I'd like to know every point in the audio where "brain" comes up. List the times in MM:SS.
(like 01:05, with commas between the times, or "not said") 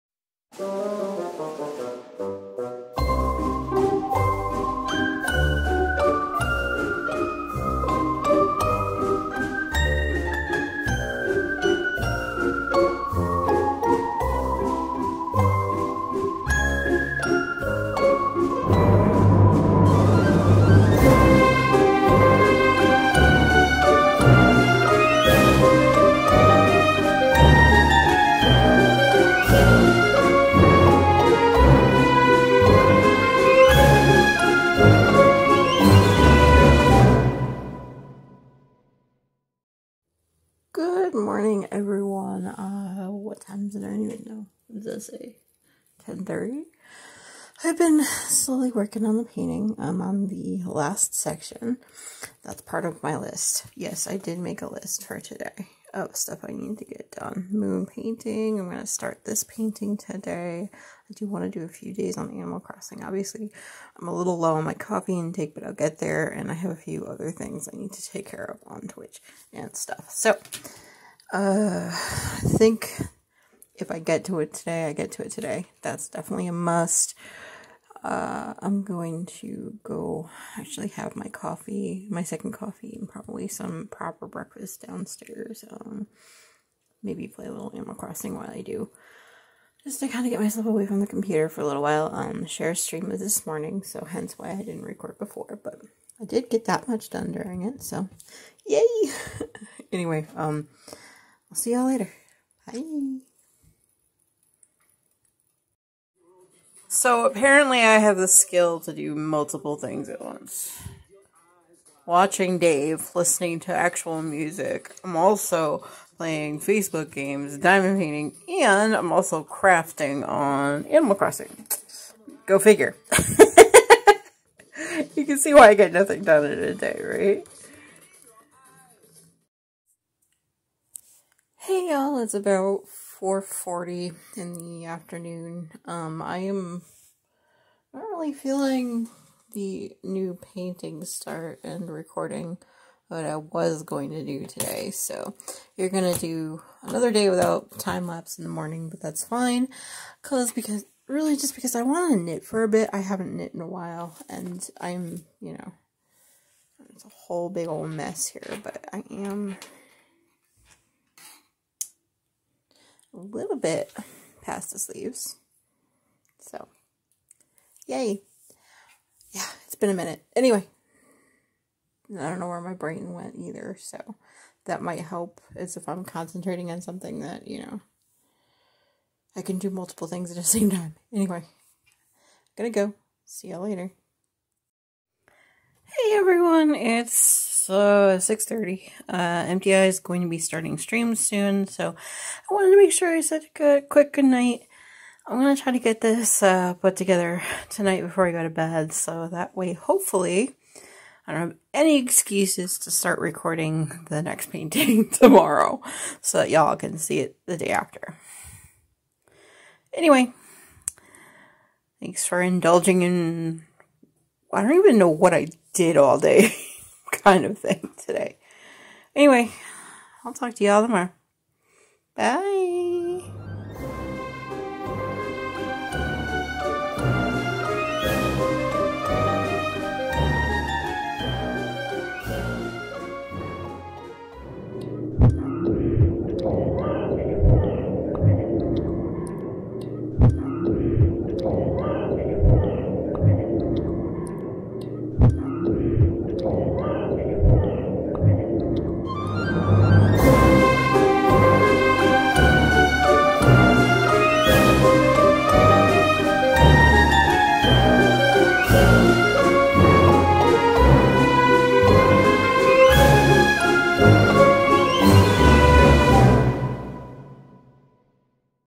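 02:52.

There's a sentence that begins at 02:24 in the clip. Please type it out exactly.
So you're going to do another day without time lapse in the morning, but that's fine.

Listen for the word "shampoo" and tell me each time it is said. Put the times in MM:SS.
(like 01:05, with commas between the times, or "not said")
not said.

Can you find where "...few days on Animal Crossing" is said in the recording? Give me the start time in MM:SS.
01:01.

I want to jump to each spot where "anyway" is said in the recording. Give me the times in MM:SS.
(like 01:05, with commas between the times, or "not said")
01:39, 02:50, 03:01, 03:29, 03:39.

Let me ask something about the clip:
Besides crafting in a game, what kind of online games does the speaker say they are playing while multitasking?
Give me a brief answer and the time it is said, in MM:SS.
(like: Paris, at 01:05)
Facebook games, at 01:56.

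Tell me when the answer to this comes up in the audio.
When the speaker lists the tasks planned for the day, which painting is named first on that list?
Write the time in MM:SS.
00:57.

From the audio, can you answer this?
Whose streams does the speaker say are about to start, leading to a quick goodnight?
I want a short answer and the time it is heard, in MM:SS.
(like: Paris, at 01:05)
MTI, at 03:09.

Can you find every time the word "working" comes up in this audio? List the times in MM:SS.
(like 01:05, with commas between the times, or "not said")
00:48.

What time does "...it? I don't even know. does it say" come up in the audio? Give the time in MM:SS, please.
00:43.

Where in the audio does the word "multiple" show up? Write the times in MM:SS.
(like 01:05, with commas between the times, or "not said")
01:49, 02:59.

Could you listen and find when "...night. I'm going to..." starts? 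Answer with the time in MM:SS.
03:14.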